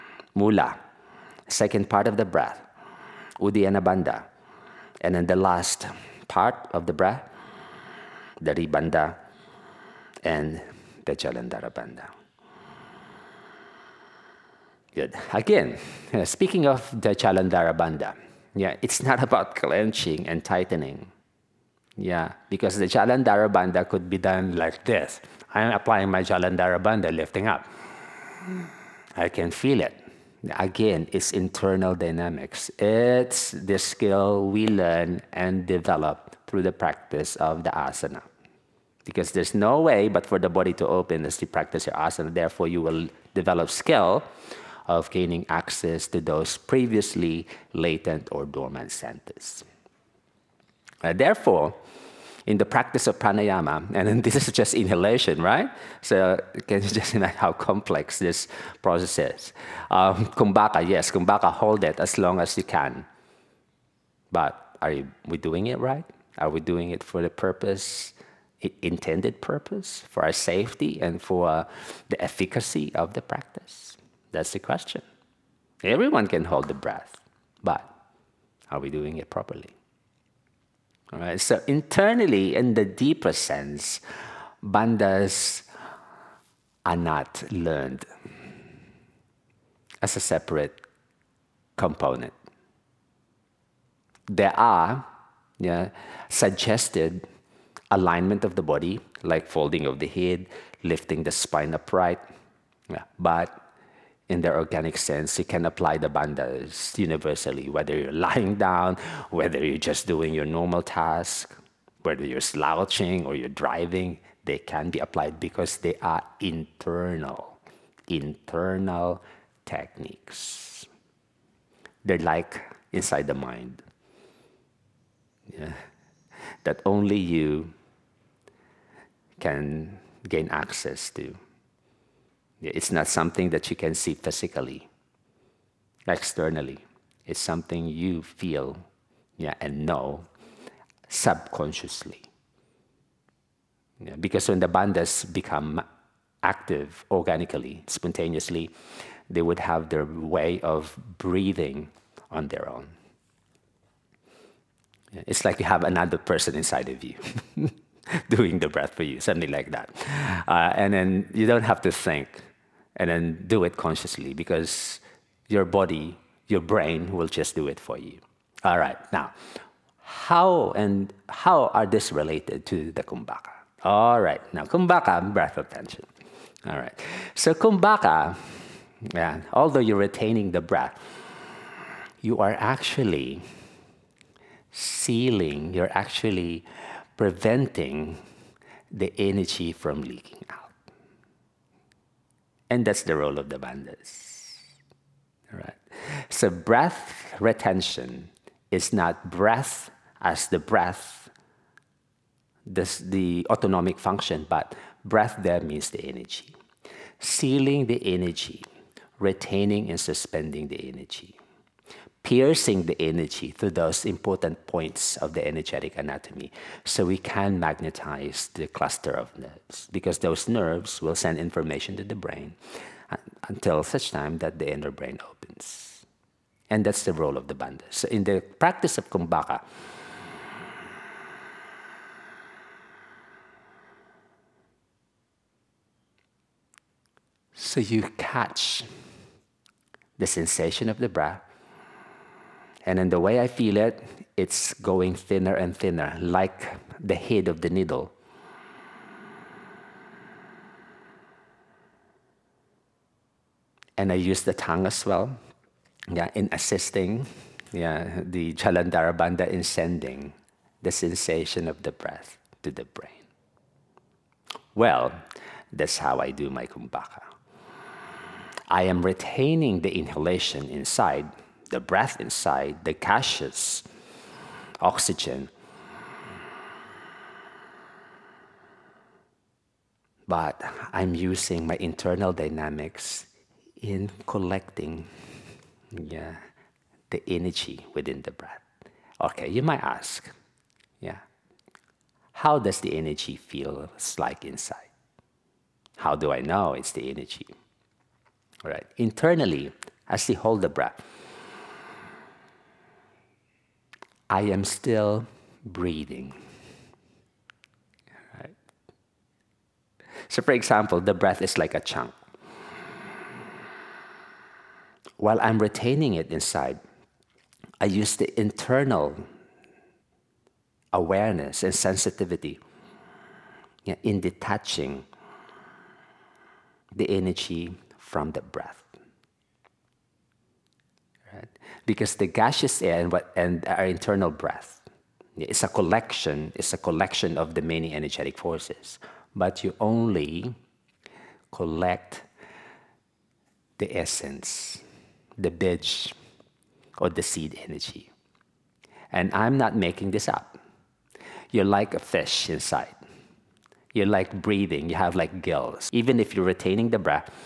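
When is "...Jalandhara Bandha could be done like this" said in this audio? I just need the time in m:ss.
0:22.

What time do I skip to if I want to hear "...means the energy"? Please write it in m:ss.
3:25.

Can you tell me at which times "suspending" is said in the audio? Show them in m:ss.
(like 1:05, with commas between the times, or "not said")
3:29.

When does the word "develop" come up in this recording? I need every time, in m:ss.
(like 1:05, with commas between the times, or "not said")
0:35, 0:43.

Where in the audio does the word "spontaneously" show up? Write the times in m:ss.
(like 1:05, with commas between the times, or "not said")
2:27.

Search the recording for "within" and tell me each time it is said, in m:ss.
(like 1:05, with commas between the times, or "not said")
4:47.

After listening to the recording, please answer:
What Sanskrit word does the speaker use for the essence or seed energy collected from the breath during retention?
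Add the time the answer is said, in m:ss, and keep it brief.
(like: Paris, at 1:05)
bija, at 5:45.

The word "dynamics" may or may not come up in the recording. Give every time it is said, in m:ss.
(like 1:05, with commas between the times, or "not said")
0:31, 4:42.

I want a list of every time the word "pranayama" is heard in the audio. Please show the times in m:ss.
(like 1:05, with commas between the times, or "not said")
0:53.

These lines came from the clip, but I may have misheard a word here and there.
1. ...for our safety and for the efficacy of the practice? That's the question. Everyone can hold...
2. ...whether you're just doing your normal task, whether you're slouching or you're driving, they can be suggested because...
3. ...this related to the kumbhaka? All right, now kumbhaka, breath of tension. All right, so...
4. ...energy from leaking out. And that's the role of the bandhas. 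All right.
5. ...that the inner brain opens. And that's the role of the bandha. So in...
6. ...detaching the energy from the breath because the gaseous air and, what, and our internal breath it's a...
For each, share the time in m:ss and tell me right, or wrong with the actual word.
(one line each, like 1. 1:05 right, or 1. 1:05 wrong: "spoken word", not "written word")
1. 1:10 right
2. 1:49 wrong: "applied", not "suggested"
3. 2:51 right
4. 3:09 right
5. 3:44 right
6. 5:24 right.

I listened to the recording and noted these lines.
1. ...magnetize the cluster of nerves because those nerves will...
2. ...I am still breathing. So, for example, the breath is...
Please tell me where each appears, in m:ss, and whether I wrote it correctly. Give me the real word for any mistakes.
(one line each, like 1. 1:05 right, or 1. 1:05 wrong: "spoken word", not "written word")
1. 3:37 right
2. 5:04 right.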